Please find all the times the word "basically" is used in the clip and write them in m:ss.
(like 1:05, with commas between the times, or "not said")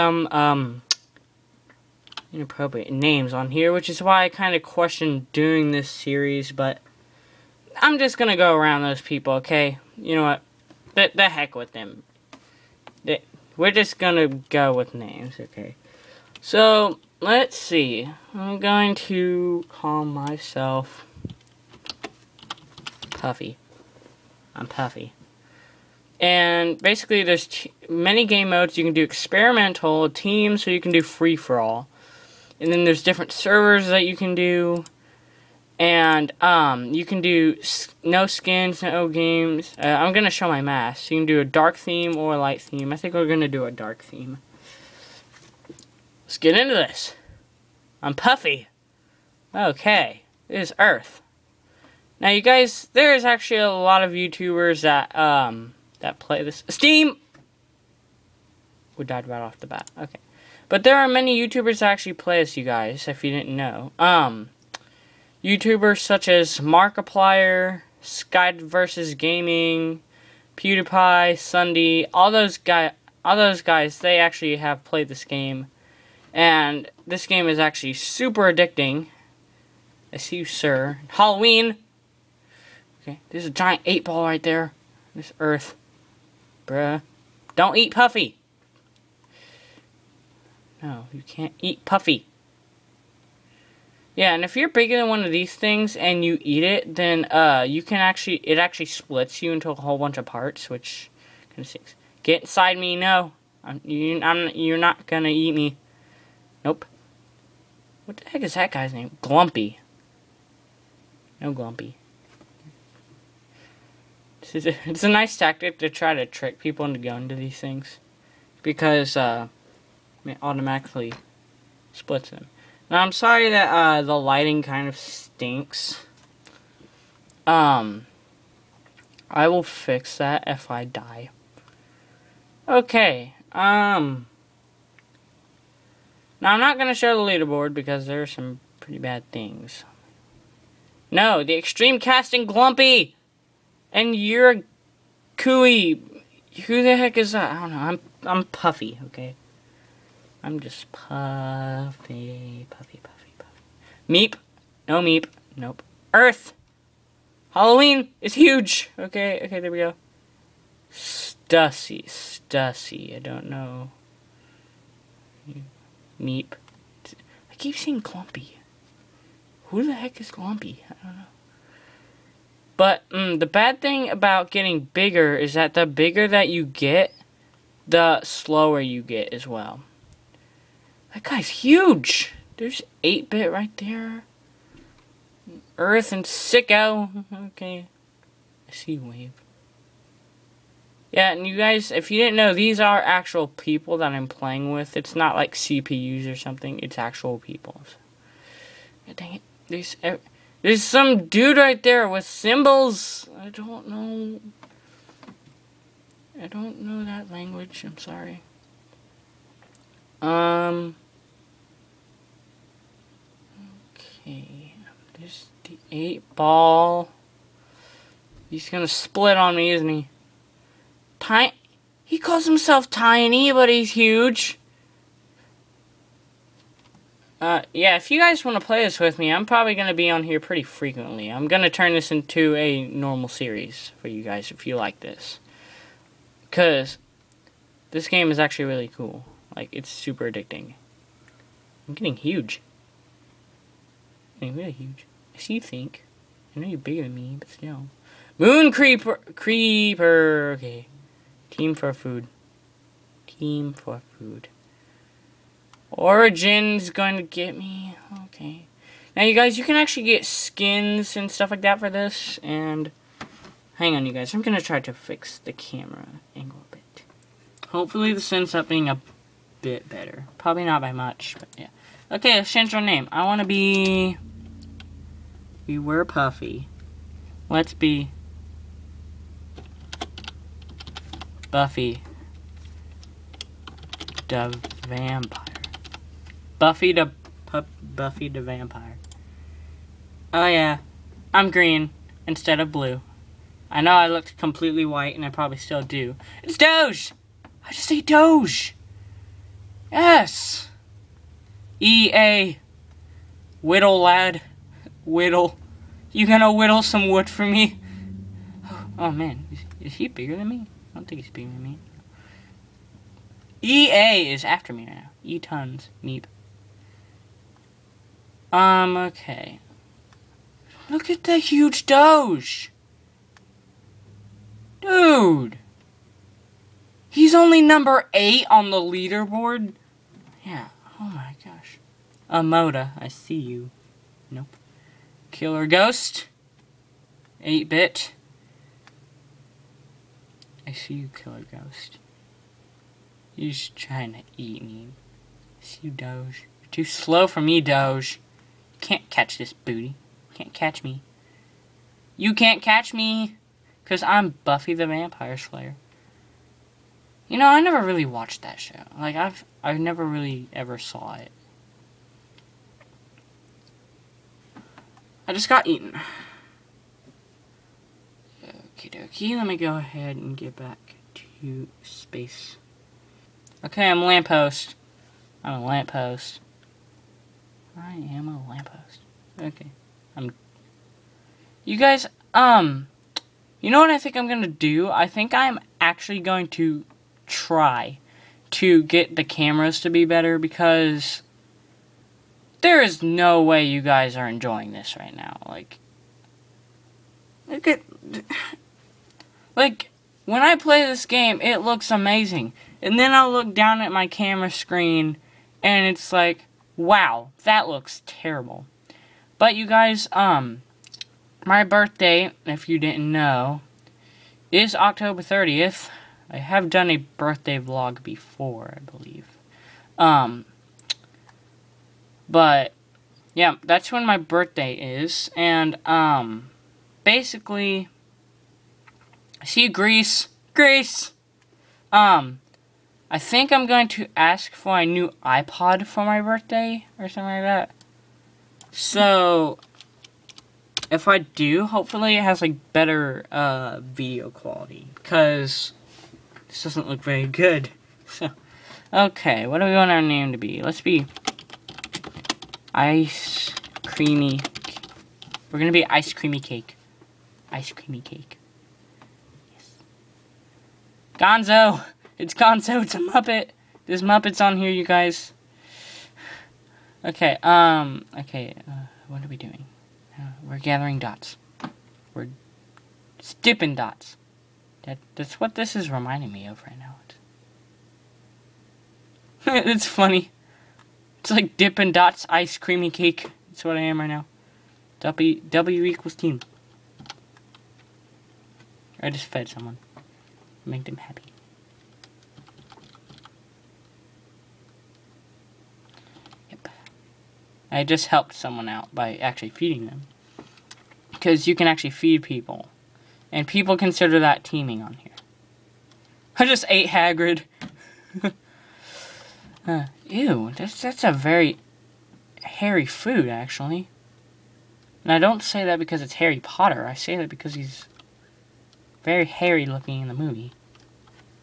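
0:26, 7:07.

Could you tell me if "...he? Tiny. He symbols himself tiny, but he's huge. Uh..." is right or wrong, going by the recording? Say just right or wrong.
wrong.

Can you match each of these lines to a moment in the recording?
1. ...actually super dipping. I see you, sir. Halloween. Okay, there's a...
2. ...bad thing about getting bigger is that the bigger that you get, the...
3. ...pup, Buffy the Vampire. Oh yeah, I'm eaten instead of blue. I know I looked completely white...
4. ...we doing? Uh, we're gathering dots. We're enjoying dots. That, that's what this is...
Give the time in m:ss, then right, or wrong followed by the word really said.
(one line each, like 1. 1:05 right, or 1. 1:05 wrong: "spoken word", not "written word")
1. 1:17 wrong: "addicting", not "dipping"
2. 2:53 right
3. 4:47 wrong: "green", not "eaten"
4. 7:49 wrong: "dipping", not "enjoying".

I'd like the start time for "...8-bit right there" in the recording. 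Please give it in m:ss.
3:03.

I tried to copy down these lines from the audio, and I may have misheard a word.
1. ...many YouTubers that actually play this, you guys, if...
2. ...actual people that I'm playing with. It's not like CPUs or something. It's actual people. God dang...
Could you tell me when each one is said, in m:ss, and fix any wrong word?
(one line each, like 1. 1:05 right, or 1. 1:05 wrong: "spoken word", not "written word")
1. 1:01 right
2. 3:12 right.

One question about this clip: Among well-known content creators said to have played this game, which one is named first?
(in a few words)
Markiplier.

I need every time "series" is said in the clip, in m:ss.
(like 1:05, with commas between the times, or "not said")
0:05, 3:53.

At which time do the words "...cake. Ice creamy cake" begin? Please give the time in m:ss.
7:36.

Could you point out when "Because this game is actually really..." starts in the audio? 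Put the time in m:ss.
3:56.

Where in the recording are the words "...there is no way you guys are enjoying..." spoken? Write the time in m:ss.
6:32.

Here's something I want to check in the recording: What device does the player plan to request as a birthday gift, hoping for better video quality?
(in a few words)
iPod.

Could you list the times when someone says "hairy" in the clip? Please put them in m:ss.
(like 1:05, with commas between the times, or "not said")
8:32, 8:39.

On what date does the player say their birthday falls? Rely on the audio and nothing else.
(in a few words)
October 30th.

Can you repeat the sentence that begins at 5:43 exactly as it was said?
You're just trying to eat me.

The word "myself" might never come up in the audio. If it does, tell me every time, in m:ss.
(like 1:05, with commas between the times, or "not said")
0:20.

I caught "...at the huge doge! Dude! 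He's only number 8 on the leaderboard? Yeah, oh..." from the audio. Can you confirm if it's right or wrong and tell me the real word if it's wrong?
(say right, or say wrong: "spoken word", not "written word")
right.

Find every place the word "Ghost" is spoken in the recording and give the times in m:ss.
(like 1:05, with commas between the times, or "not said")
5:35, 5:41.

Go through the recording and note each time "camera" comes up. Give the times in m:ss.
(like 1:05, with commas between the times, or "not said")
4:25, 6:29, 6:44.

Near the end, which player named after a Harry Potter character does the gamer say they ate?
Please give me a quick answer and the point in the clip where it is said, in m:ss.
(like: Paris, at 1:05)
Hagrid, at 8:26.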